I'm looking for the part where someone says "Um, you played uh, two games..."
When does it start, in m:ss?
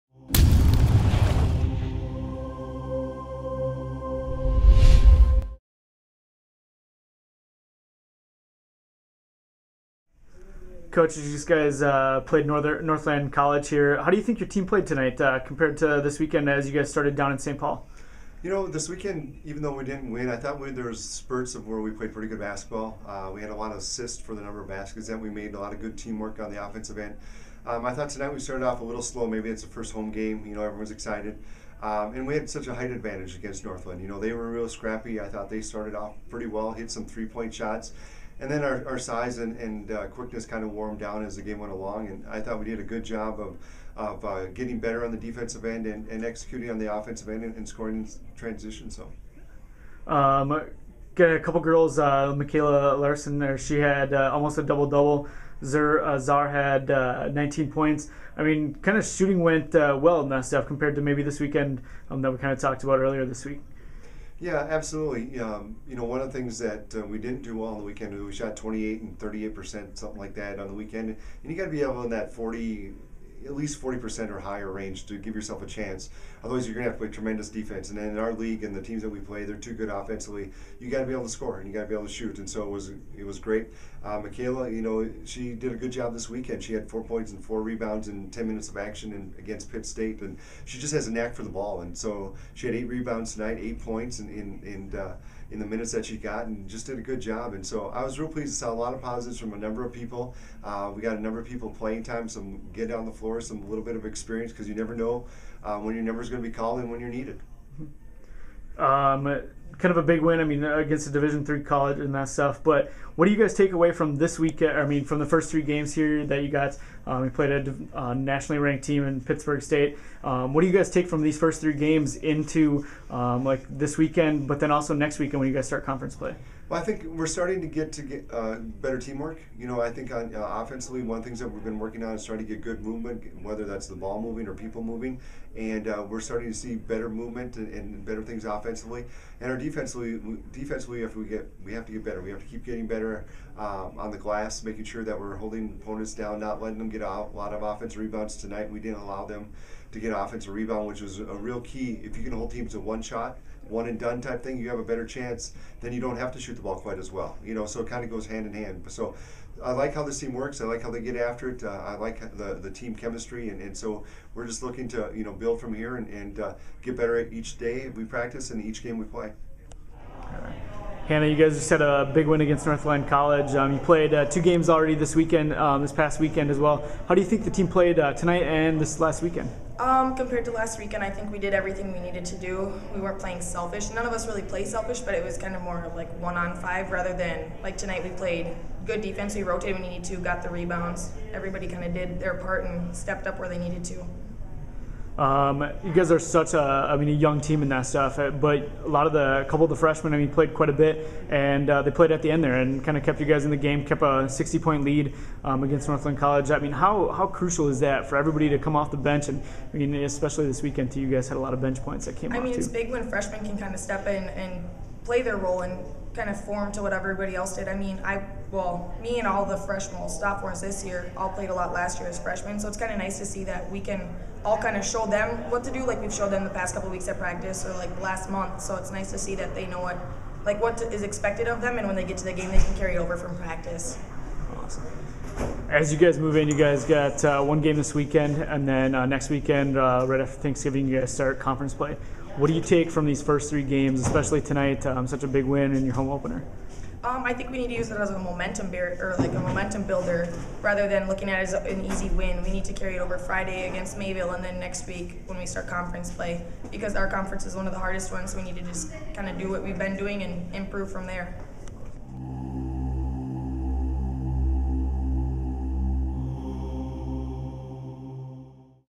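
2:53.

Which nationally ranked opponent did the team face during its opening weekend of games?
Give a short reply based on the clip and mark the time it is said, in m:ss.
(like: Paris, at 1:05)
Pittsburg State, at 1:59.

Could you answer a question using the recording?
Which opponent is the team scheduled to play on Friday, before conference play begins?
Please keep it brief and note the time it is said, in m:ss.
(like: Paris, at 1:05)
Mayville, at 4:13.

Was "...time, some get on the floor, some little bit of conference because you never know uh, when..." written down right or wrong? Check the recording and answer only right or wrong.
wrong.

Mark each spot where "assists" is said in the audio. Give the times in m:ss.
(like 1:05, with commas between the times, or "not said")
0:23.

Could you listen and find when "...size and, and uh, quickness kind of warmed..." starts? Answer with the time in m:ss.
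0:38.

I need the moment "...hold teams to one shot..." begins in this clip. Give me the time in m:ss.
2:32.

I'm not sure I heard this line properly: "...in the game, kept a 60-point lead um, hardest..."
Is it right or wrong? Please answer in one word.
wrong.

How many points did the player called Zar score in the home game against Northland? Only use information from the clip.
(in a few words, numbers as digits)
19.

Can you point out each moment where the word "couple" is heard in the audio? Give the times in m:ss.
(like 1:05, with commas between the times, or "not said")
0:51, 3:19, 3:46.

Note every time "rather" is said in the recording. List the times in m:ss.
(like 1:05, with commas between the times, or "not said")
3:06, 4:10.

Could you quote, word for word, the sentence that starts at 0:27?
Um, I thought tonight we started off a little slow.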